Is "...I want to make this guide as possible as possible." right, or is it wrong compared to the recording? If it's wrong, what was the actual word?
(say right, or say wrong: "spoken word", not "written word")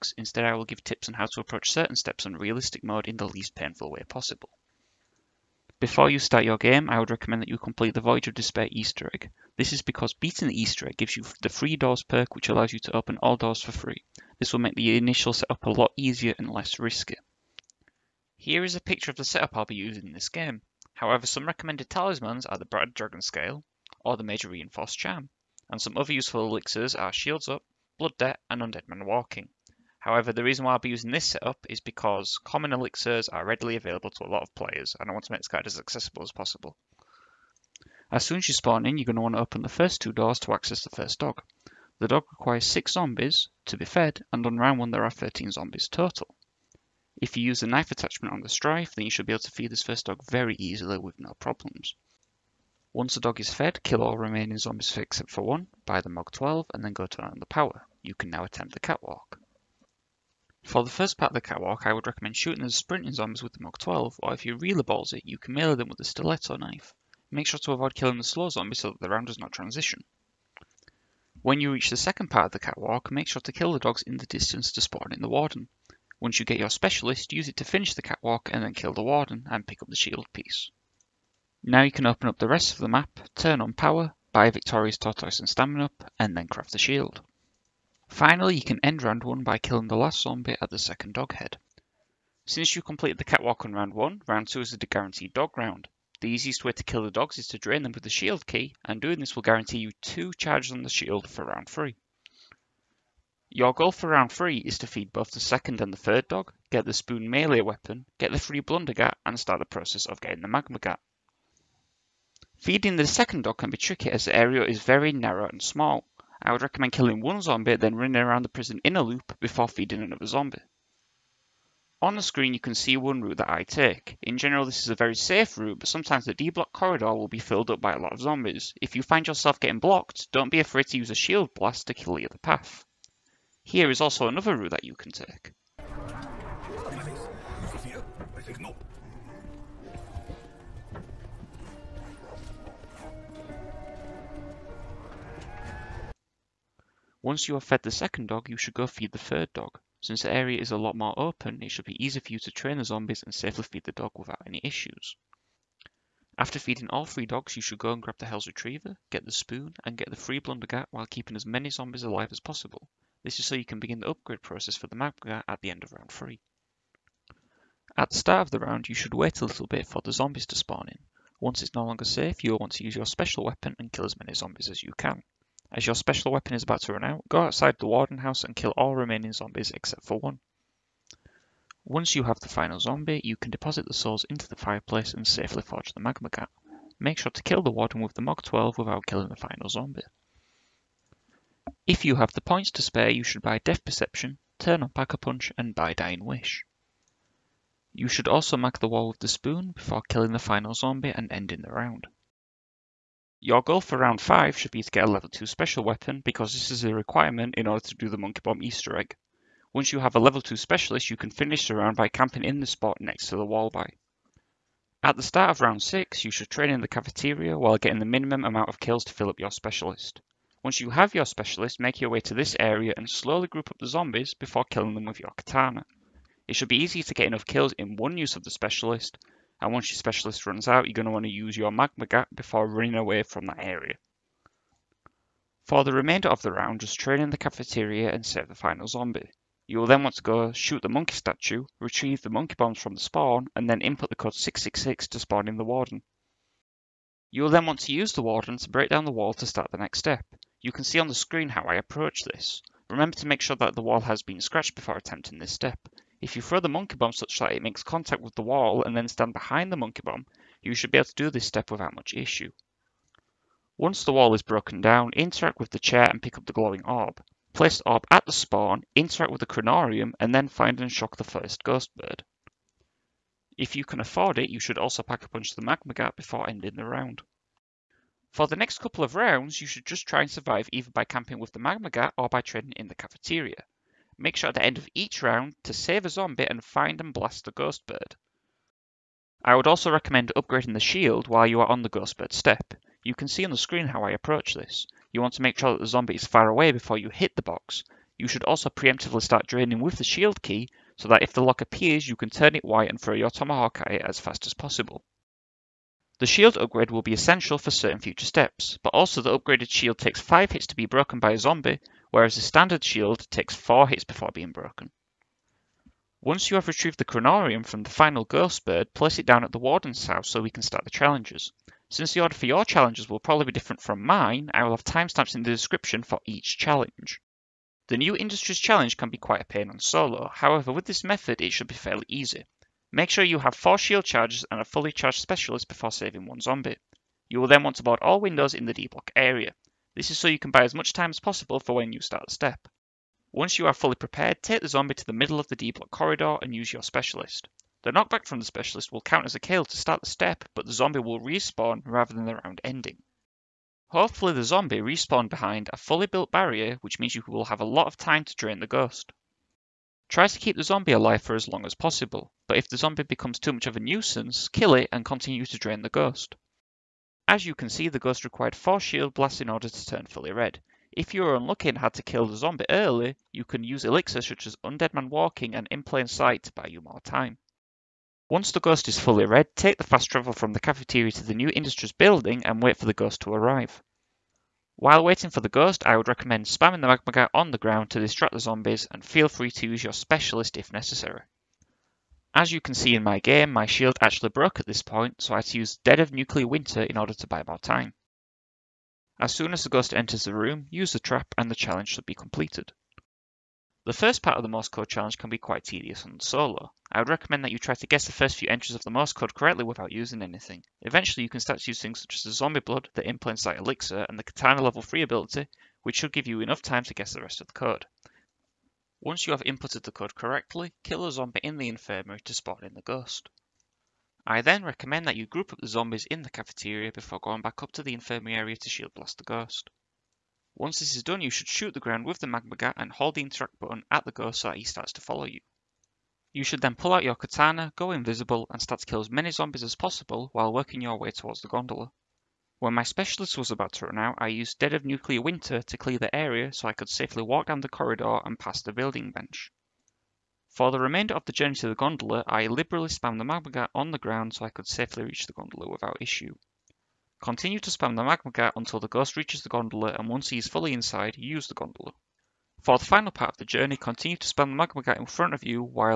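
wrong: "accessible", not "possible".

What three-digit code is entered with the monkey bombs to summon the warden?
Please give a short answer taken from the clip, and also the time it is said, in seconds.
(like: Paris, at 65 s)
666, at 244 s.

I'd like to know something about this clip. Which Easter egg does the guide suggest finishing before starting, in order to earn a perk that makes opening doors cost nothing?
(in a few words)
Voyage of Despair.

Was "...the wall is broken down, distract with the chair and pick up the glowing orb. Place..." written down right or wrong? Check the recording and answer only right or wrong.
wrong.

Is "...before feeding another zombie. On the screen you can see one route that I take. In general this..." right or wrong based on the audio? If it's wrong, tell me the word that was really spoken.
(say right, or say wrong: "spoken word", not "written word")
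right.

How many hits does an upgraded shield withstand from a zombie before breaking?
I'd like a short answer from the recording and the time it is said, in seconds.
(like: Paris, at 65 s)
5, at 310 s.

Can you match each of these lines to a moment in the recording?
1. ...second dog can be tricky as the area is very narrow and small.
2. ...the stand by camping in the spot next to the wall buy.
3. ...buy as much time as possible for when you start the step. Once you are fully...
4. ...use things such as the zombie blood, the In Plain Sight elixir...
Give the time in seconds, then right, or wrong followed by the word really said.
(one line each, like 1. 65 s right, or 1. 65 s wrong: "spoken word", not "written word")
1. 113 s right
2. 211 s wrong: "round", not "stand"
3. 340 s right
4. 411 s right.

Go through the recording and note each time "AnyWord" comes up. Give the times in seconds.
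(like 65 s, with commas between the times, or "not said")
not said.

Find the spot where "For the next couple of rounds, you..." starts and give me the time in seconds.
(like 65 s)
278 s.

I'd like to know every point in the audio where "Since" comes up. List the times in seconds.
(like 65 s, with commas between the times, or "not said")
92 s, 150 s, 321 s.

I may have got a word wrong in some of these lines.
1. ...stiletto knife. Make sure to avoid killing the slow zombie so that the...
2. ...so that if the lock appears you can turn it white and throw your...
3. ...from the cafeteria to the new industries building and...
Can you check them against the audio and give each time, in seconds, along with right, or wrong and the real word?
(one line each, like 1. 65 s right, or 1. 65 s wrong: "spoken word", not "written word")
1. 66 s right
2. 300 s right
3. 380 s right.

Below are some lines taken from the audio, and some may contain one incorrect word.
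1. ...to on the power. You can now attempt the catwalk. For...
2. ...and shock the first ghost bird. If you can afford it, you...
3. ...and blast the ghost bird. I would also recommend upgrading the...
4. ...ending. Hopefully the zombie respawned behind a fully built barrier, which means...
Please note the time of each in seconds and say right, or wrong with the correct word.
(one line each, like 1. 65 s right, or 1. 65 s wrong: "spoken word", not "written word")
1. 57 s right
2. 270 s right
3. 287 s right
4. 352 s right.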